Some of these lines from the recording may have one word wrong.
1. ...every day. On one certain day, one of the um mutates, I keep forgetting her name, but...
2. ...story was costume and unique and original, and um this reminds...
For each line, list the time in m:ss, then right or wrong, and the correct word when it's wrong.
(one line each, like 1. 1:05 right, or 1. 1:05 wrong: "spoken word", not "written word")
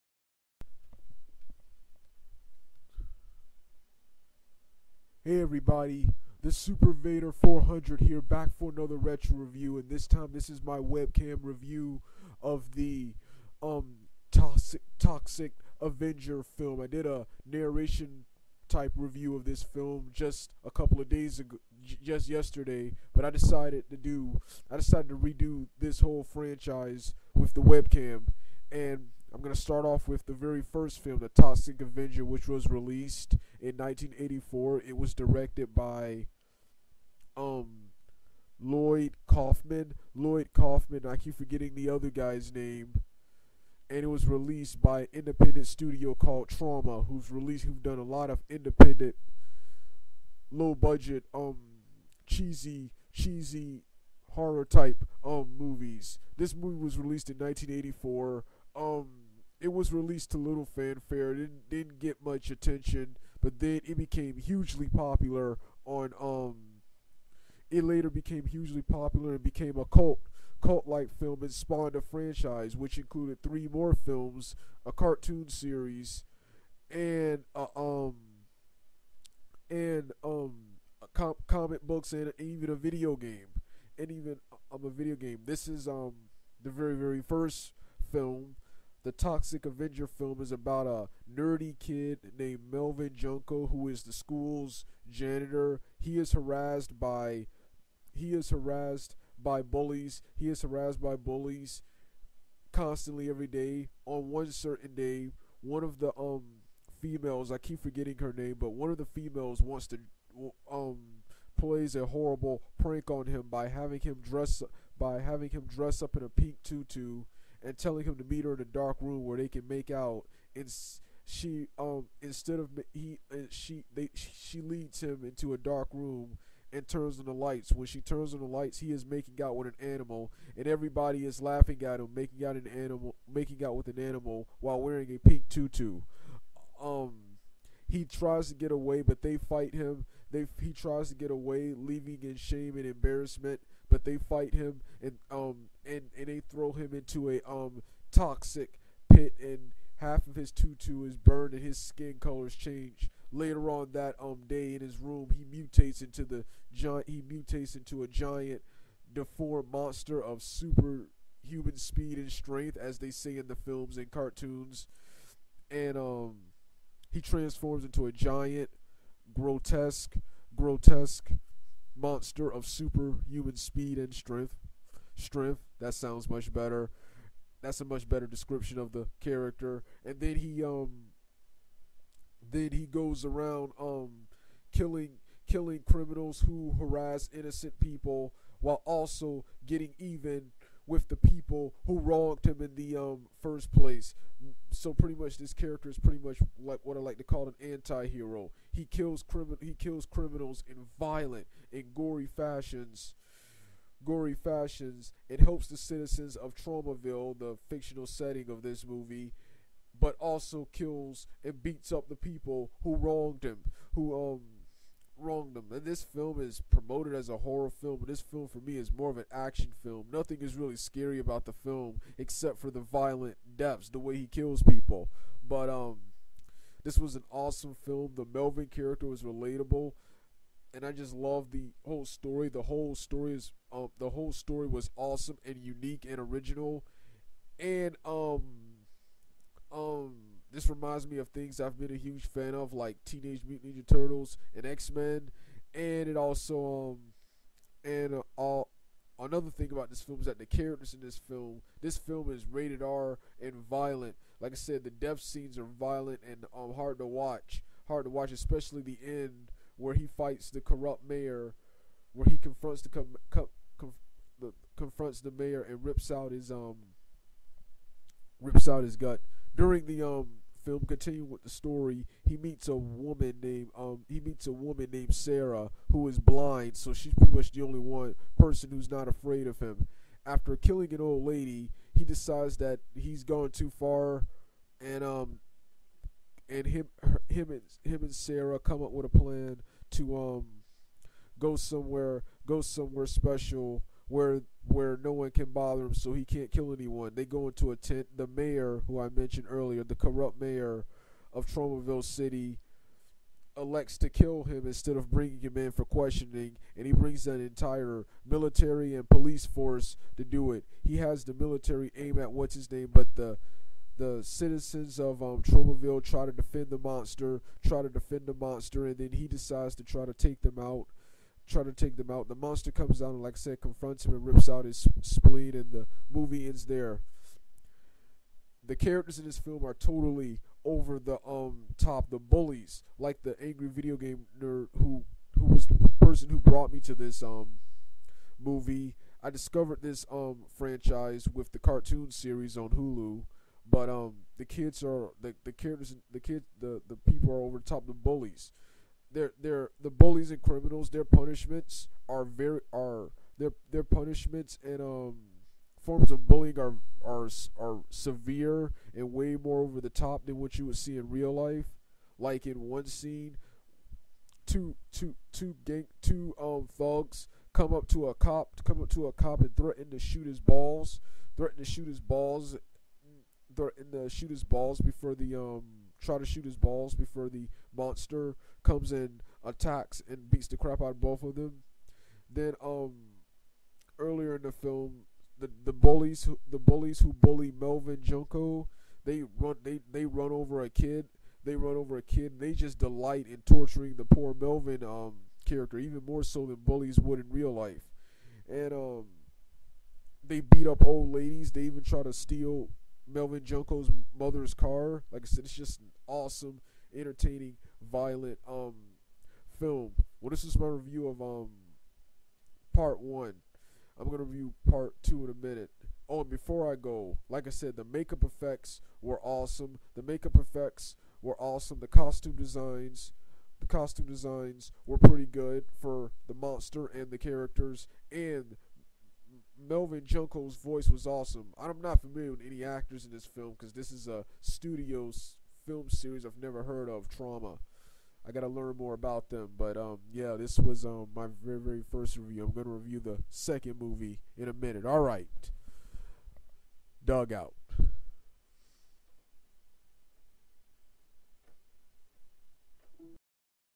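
1. 1:43 wrong: "females", not "mutates"
2. 3:54 wrong: "awesome", not "costume".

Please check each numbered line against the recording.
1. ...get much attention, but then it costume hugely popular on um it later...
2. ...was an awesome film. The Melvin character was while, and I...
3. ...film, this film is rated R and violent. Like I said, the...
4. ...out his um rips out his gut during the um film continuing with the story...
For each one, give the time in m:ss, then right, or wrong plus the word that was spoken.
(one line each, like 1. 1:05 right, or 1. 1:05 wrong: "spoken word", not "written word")
1. 1:01 wrong: "became", not "costume"
2. 3:46 wrong: "relatable", not "while"
3. 4:11 right
4. 4:26 right.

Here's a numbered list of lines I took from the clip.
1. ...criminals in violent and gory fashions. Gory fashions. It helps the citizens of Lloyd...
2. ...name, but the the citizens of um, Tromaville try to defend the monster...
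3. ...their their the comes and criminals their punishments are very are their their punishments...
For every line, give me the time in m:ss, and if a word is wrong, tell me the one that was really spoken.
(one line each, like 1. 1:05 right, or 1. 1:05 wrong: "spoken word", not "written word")
1. 3:20 wrong: "Tromaville", not "Lloyd"
2. 5:12 right
3. 5:49 wrong: "bullies", not "comes".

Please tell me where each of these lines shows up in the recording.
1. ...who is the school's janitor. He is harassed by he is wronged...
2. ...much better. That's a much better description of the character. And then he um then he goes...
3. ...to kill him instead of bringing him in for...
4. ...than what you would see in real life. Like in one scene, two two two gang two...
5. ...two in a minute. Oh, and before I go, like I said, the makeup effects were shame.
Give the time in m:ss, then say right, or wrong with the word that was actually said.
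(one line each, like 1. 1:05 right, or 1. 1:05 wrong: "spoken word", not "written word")
1. 1:33 wrong: "harassed", not "wronged"
2. 2:56 right
3. 5:03 right
4. 6:00 right
5. 6:55 wrong: "awesome", not "shame".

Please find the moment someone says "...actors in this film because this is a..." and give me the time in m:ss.
7:12.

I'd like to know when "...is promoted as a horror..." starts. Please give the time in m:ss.
3:36.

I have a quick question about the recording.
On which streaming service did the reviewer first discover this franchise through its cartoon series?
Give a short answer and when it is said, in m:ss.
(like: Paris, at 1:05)
Hulu, at 5:42.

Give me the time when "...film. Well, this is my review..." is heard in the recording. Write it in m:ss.
6:49.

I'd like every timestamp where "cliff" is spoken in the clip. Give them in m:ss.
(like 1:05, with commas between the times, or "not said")
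not said.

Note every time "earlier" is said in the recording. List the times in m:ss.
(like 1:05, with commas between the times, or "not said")
4:59, 6:23.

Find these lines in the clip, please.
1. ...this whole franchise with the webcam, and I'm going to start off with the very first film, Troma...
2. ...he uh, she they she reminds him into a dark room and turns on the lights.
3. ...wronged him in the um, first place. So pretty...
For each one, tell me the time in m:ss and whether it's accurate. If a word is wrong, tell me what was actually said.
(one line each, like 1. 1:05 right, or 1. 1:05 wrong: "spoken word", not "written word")
1. 0:25 wrong: "The", not "Troma"
2. 2:02 wrong: "leads", not "reminds"
3. 3:11 right.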